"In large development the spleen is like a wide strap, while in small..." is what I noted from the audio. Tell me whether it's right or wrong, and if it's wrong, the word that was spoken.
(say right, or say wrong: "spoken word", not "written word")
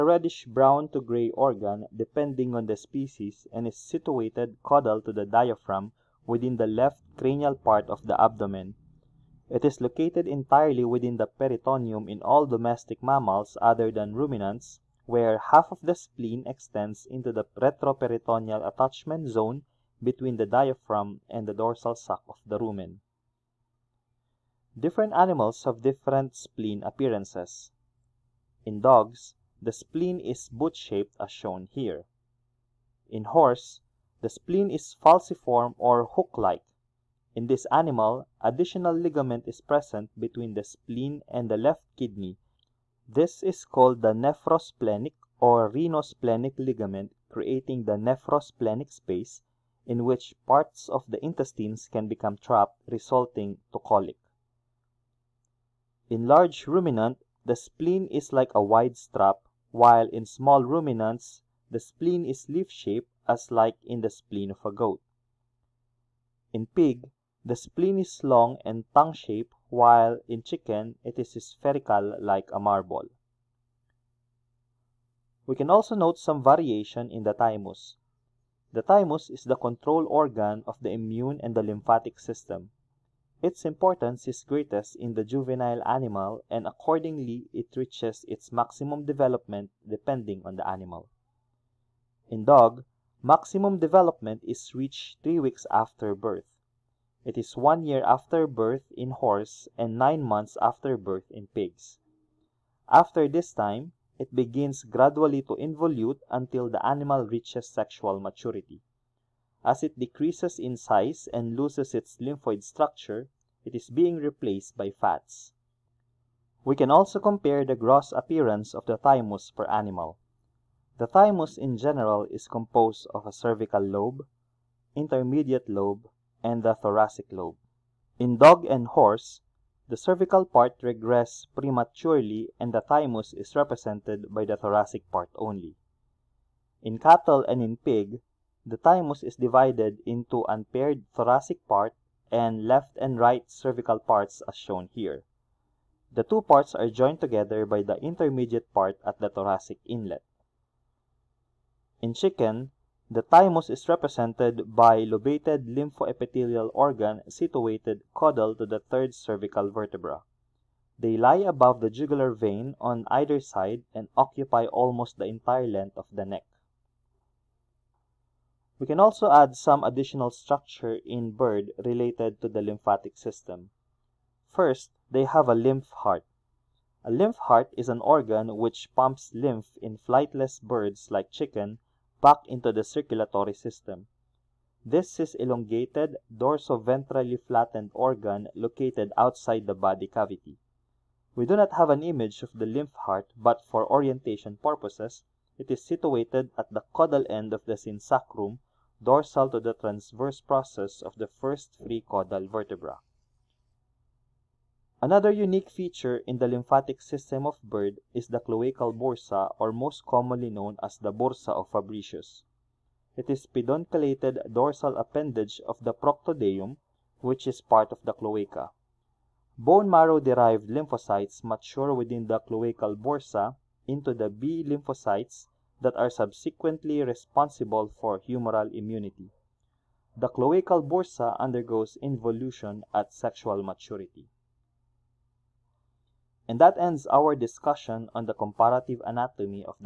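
wrong: "ruminant", not "development".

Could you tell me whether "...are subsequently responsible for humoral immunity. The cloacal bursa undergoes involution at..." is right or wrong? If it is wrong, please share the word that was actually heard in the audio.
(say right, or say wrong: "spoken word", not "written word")
right.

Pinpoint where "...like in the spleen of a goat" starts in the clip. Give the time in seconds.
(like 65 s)
63 s.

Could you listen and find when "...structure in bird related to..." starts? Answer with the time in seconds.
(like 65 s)
170 s.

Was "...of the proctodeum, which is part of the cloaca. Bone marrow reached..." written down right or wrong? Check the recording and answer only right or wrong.
wrong.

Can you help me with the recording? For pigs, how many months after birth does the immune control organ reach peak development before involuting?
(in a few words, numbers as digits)
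9 months.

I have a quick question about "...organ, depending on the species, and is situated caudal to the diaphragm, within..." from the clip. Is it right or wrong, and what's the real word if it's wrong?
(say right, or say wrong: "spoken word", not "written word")
right.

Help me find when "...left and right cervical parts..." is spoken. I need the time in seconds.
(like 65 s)
142 s.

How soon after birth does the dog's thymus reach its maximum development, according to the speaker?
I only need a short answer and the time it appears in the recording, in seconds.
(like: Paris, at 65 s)
3 weeks, at 95 s.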